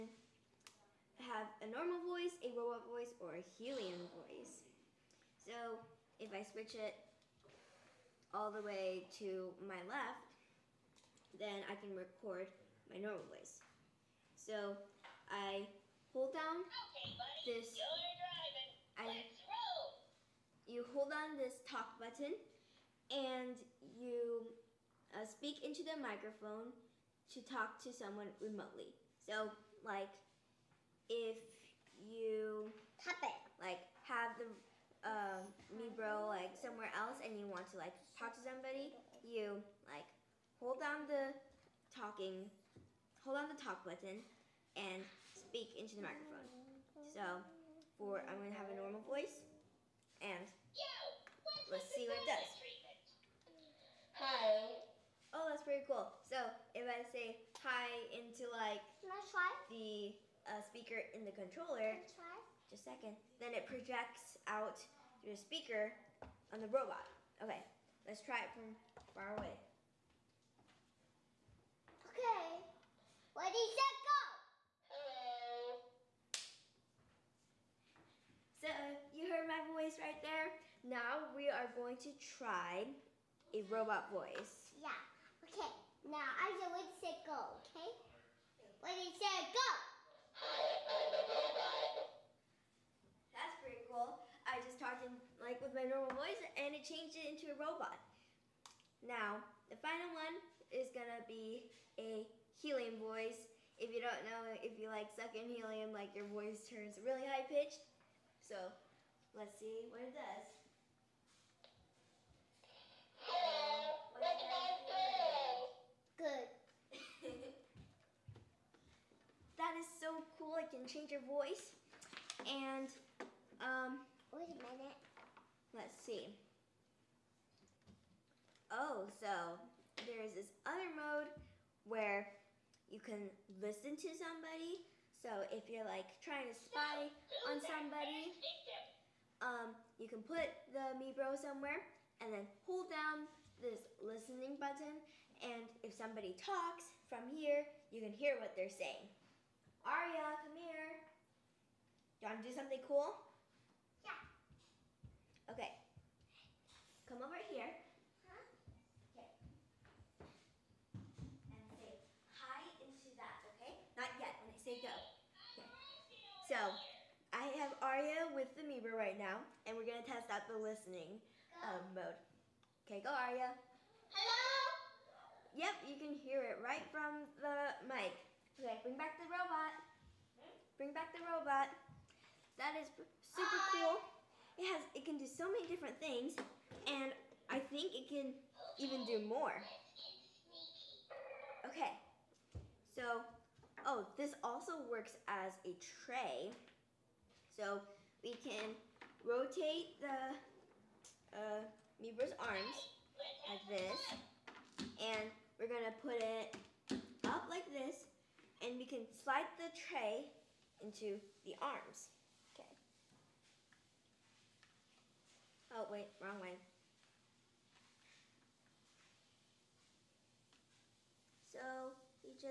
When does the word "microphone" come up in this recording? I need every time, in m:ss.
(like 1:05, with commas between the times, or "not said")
0:25, 0:46.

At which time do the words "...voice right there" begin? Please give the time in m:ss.
1:19.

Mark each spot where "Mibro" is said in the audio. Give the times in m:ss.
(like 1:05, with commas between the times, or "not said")
0:35, 2:20, 2:48, 3:22.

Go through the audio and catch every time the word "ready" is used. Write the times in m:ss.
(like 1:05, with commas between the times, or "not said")
1:13.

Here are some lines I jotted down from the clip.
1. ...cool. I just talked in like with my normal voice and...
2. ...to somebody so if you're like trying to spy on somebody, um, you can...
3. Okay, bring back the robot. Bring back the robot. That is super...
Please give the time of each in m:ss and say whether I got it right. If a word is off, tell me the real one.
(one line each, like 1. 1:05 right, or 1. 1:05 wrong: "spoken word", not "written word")
1. 1:33 right
2. 2:13 right
3. 2:58 right.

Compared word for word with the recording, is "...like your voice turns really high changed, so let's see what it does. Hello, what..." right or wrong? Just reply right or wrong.
wrong.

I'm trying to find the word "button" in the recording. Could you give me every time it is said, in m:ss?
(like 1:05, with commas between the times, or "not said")
0:21, 0:43, 2:24.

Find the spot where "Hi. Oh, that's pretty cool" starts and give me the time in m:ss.
0:54.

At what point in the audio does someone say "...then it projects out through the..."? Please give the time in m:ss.
1:03.